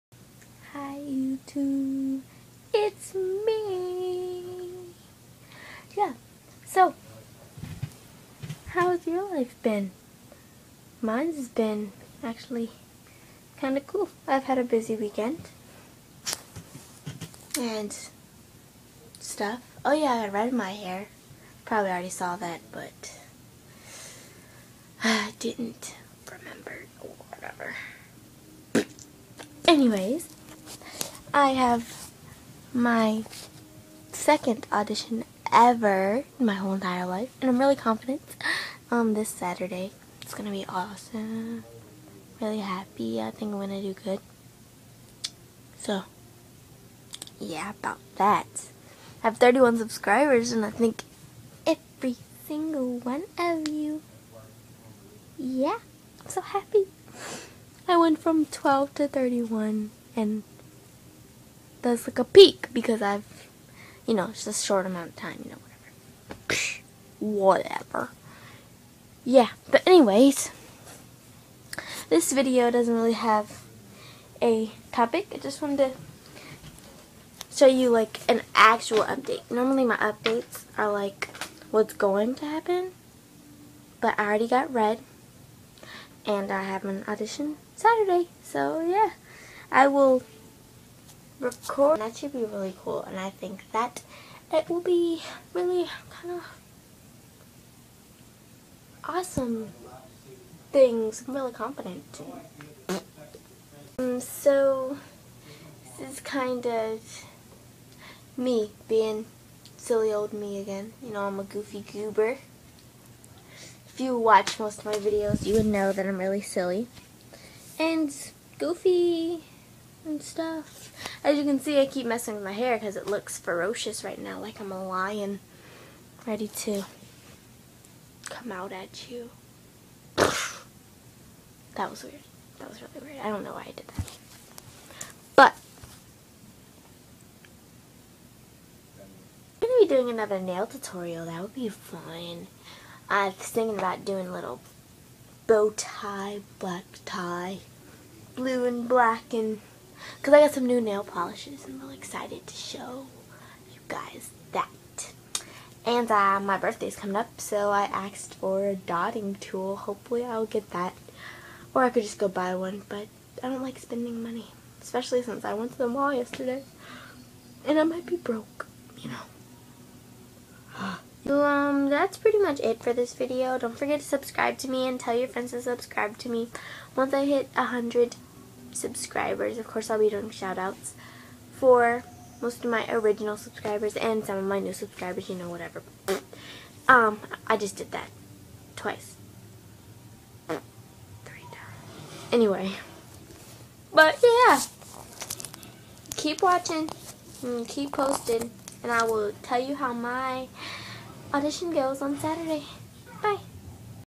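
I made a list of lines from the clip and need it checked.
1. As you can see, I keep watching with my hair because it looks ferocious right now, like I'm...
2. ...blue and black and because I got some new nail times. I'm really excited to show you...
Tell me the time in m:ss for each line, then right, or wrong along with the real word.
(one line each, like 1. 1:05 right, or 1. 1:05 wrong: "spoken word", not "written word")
1. 2:01 wrong: "messing", not "watching"
2. 2:28 wrong: "polishes", not "times".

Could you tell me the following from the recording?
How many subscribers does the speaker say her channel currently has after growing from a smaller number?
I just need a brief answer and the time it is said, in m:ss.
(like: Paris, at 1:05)
31, at 0:49.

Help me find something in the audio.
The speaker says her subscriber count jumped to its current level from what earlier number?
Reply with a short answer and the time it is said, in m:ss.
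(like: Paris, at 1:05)
12, at 0:57.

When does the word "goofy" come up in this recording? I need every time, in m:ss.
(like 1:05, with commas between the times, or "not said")
1:51, 1:58.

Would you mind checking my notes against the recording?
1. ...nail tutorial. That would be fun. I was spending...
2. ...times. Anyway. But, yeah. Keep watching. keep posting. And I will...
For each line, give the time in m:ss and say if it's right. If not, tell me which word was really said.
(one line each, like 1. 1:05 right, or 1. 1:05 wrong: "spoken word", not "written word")
1. 2:20 wrong: "thinking", not "spending"
2. 3:11 right.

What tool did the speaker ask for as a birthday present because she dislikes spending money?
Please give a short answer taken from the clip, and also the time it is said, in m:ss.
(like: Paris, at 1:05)
dotting tool, at 2:38.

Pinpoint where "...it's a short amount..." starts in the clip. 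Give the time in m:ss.
1:04.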